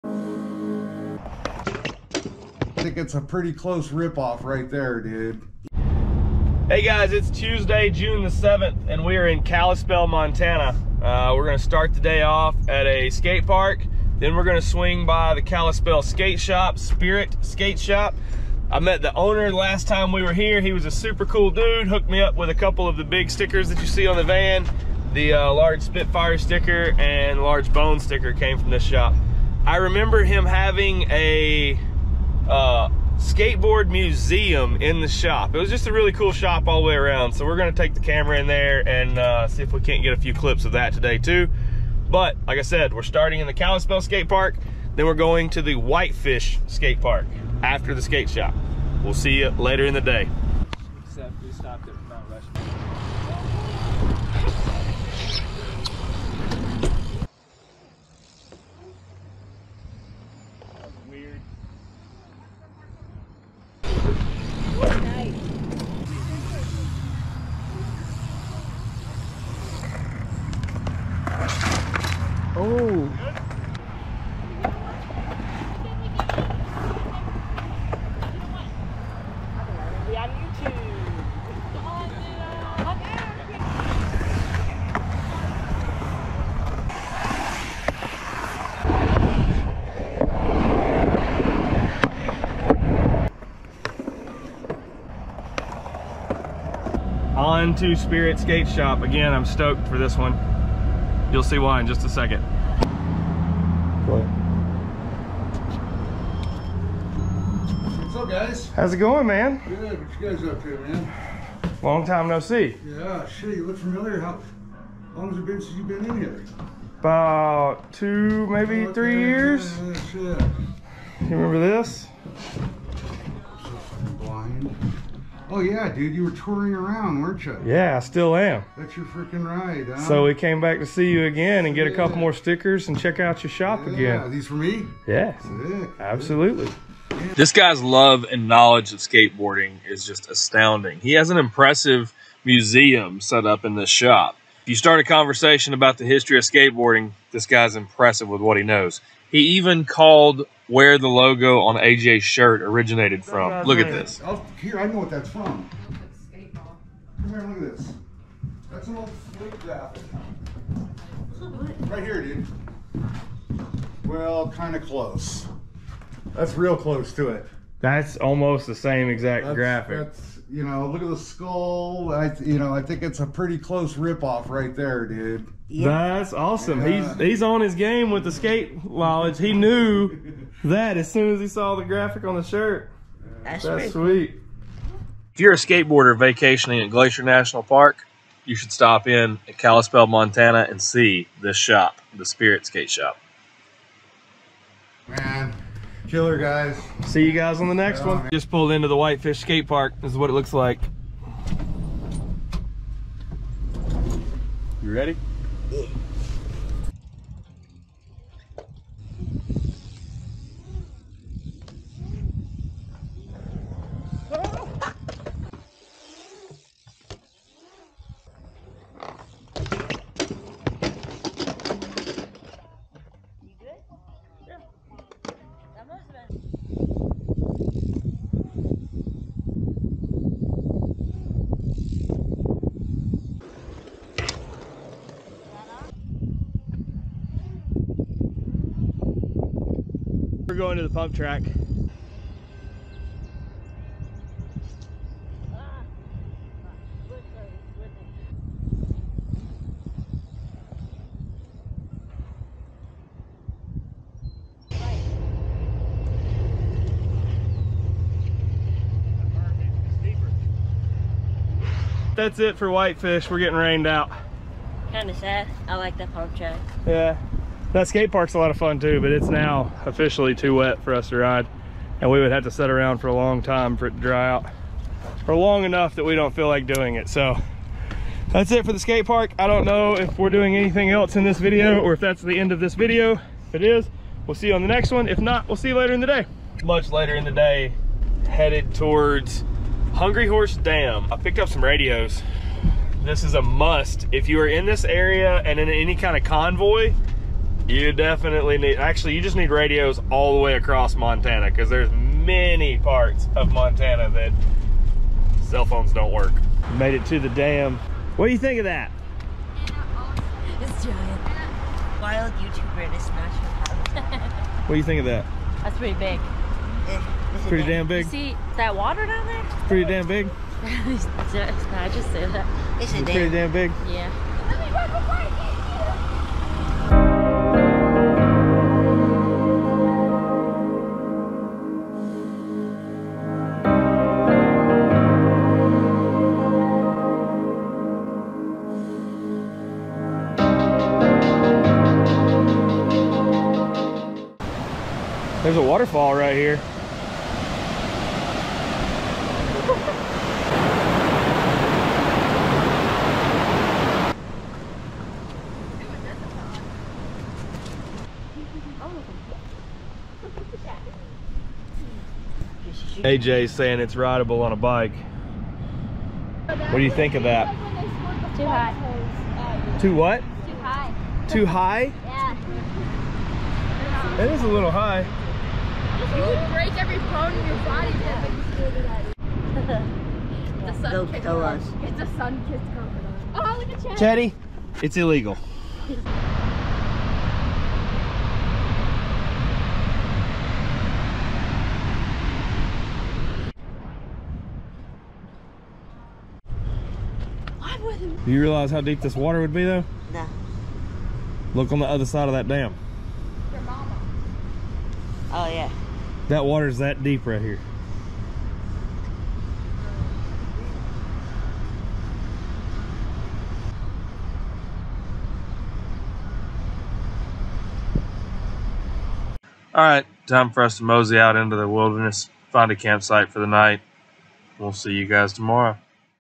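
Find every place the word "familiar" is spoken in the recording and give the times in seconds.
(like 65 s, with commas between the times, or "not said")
113 s.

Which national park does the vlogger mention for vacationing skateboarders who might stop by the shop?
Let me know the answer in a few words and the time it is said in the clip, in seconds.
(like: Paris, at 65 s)
Glacier National Park, at 186 s.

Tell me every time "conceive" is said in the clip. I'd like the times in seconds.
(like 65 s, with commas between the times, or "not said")
not said.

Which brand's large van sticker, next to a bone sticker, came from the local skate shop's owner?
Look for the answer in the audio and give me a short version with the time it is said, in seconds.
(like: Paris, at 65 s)
Spitfire, at 25 s.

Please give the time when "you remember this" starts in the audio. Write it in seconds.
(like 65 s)
120 s.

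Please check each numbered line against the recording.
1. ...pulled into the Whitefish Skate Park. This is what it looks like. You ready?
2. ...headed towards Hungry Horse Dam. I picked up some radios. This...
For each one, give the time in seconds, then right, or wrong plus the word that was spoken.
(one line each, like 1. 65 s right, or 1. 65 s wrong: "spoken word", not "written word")
1. 198 s right
2. 288 s right.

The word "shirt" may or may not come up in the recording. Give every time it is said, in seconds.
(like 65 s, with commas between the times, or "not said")
152 s, 182 s.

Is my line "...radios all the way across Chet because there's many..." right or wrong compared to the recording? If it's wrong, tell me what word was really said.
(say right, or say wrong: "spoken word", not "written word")
wrong: "Montana", not "Chet".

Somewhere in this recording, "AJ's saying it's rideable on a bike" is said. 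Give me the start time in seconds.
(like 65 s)
363 s.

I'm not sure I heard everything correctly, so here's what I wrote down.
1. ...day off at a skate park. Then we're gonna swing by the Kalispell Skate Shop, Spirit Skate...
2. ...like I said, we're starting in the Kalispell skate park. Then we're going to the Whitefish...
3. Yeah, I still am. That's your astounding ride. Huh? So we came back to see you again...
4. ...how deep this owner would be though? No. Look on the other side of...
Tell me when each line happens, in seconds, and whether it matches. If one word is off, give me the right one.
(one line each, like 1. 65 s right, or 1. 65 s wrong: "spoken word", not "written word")
1. 11 s right
2. 42 s right
3. 127 s wrong: "freaking", not "astounding"
4. 398 s wrong: "water", not "owner".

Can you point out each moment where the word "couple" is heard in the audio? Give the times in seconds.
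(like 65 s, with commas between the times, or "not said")
22 s, 131 s.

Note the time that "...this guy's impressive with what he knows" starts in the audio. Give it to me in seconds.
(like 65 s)
147 s.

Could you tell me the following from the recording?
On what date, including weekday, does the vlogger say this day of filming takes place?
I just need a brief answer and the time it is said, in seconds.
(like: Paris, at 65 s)
Tuesday, June 7th, at 7 s.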